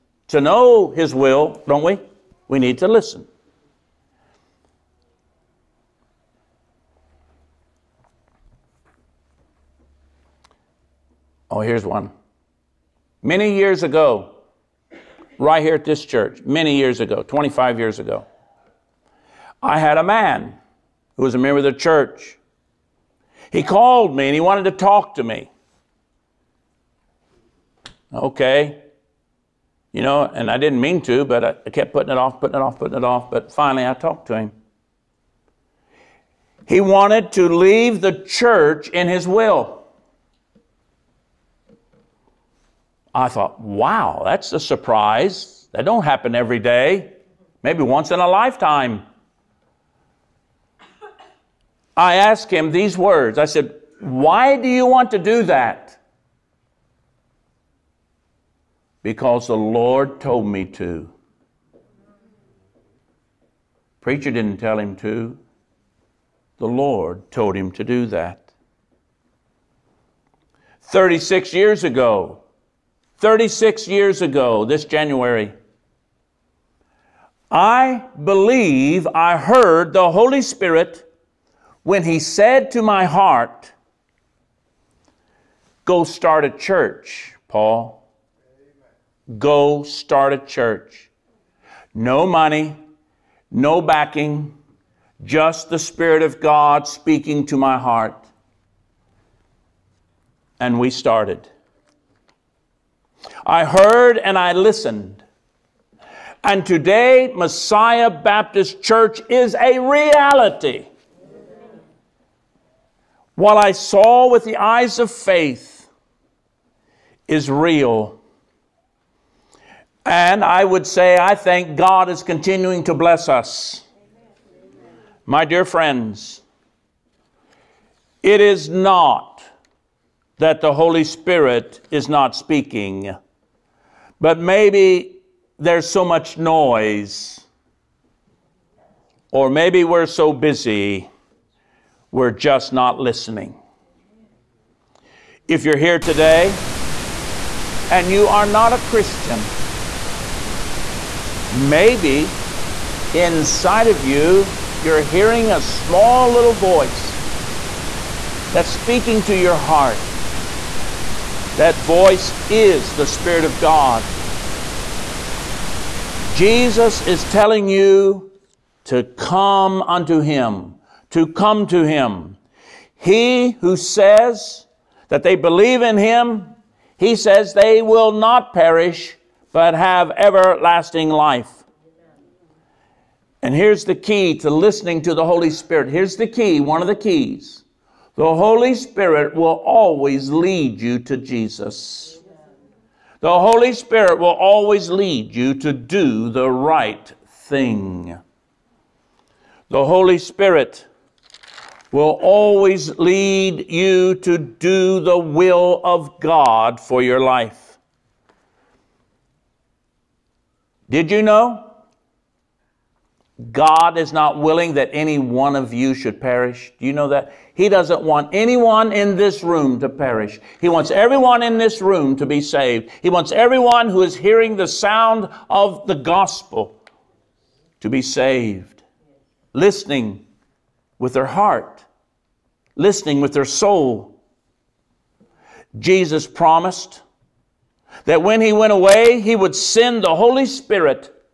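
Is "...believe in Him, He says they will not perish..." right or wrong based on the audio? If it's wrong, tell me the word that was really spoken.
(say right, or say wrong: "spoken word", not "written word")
right.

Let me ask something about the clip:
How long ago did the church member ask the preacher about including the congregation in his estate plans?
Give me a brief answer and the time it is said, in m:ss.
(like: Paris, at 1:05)
25 years, at 0:17.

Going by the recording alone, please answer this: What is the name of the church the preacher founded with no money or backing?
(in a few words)
Messiah Baptist Church.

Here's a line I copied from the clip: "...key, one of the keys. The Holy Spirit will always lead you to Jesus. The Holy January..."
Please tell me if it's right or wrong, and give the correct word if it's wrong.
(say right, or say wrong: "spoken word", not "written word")
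wrong: "Spirit", not "January".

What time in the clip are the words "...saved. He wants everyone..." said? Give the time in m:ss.
3:42.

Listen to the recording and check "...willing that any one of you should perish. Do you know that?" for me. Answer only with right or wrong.
right.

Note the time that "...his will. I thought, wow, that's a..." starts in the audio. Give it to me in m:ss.
0:39.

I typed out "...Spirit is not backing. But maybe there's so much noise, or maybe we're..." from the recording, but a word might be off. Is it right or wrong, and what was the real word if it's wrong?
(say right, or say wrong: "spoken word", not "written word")
wrong: "speaking", not "backing".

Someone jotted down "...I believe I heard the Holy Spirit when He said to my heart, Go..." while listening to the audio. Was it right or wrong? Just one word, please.
right.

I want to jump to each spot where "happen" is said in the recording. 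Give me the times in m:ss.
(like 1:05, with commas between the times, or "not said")
0:46.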